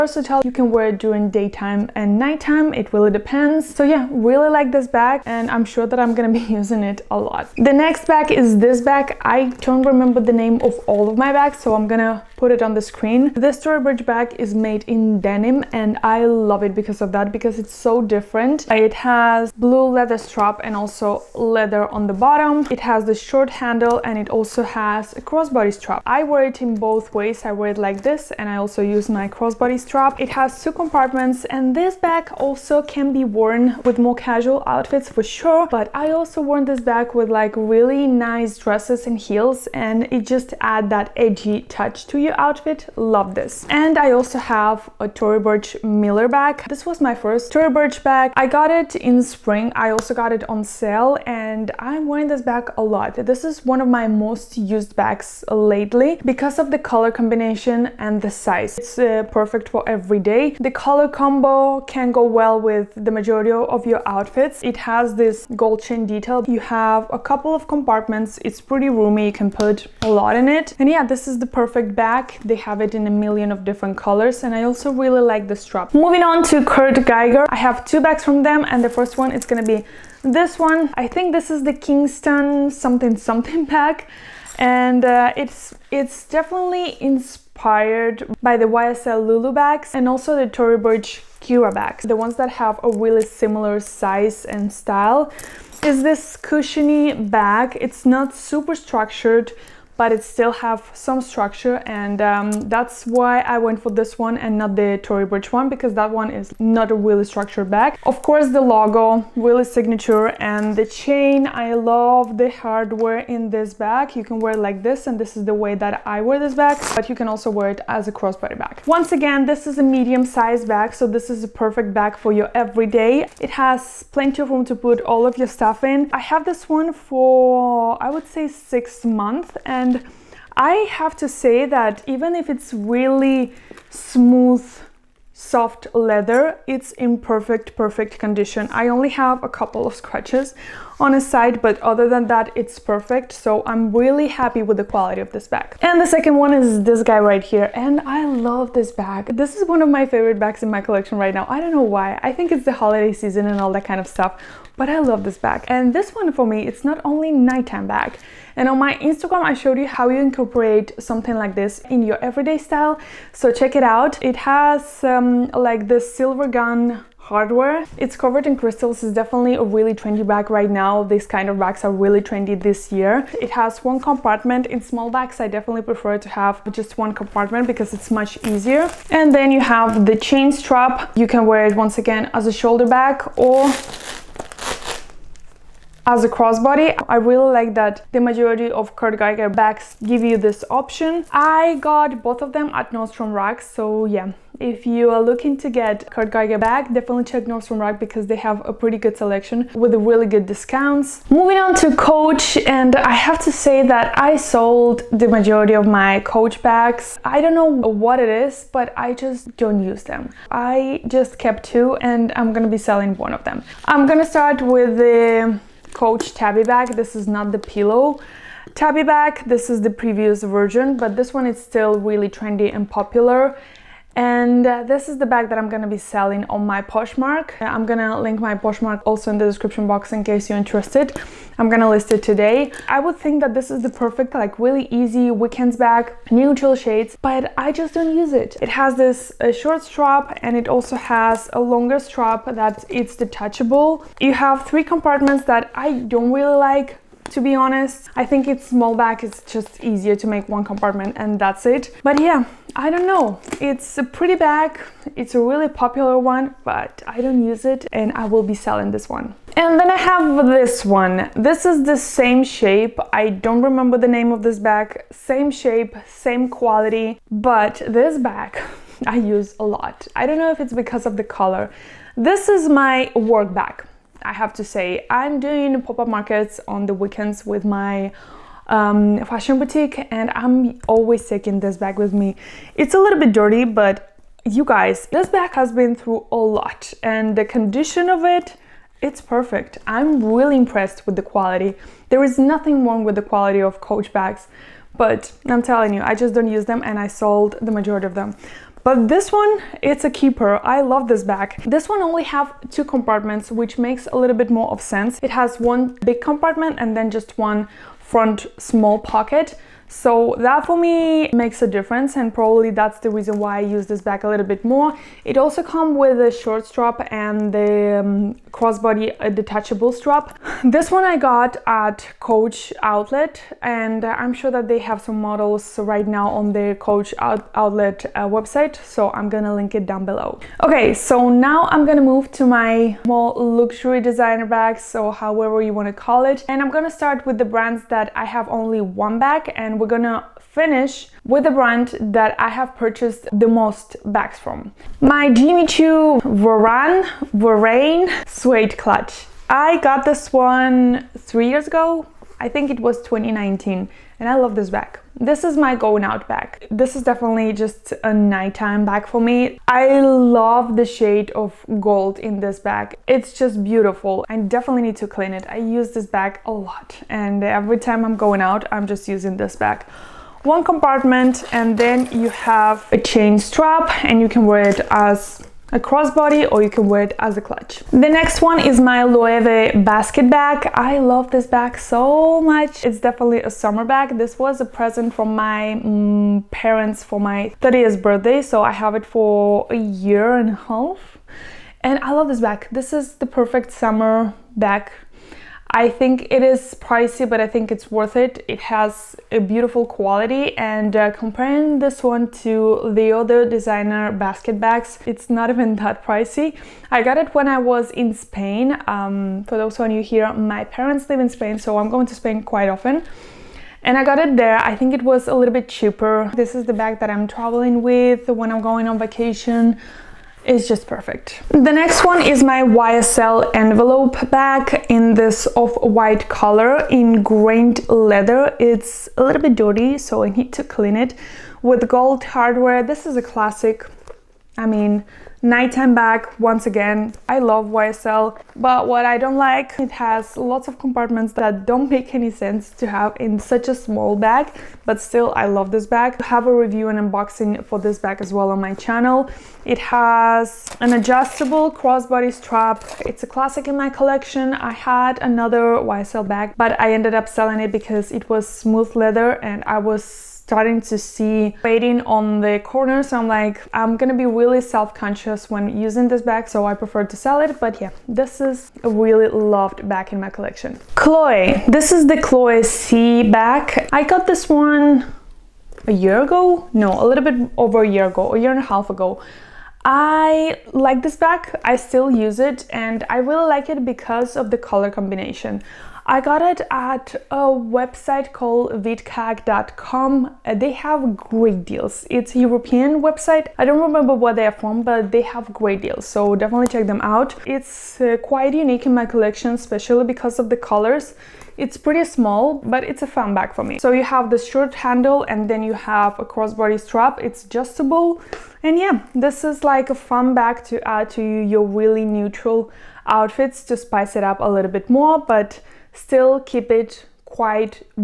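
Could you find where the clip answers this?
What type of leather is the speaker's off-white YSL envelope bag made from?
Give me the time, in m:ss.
7:07.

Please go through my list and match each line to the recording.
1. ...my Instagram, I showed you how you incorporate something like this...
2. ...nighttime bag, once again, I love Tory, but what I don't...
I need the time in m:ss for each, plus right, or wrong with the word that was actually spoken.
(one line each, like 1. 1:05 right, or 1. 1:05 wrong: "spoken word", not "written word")
1. 2:38 right
2. 7:15 wrong: "YSL", not "Tory".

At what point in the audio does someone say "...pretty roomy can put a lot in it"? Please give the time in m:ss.
1:08.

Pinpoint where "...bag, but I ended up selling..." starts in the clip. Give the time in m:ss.
7:36.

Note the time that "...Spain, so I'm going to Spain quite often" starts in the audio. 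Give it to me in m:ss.
6:51.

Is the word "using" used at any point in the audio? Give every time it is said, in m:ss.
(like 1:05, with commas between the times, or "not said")
0:06, 6:09, 7:45.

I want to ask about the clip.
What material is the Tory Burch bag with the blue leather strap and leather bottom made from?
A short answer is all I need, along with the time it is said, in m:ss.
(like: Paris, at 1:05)
Denim, at 0:15.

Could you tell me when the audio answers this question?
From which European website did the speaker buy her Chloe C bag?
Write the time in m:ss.
8:08.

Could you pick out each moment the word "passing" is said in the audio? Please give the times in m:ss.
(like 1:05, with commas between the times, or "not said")
not said.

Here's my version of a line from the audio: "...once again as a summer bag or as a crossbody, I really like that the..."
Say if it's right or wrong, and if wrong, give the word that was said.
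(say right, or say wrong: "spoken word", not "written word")
wrong: "shoulder", not "summer".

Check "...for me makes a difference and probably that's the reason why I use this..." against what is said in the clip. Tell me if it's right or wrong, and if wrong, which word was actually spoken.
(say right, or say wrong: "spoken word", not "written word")
right.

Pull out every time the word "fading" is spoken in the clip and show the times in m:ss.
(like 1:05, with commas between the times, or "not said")
7:41.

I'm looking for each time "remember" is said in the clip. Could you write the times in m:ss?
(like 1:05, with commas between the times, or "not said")
0:09, 4:23, 8:13.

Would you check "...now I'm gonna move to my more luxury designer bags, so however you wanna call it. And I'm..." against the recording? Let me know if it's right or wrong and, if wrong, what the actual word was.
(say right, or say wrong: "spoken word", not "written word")
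right.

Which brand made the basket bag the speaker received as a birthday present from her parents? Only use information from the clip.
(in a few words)
Loewe.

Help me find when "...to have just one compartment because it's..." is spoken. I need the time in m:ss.
2:56.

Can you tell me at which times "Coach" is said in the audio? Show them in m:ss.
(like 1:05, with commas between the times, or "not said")
3:21, 3:26, 3:35, 4:53, 5:22, 5:26.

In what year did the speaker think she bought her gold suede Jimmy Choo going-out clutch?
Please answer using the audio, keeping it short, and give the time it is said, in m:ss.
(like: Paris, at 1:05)
2019, at 5:53.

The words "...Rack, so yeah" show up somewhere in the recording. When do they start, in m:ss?
3:13.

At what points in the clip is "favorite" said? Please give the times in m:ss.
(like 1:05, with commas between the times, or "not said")
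2:30.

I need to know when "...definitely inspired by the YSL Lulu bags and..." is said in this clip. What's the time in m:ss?
1:26.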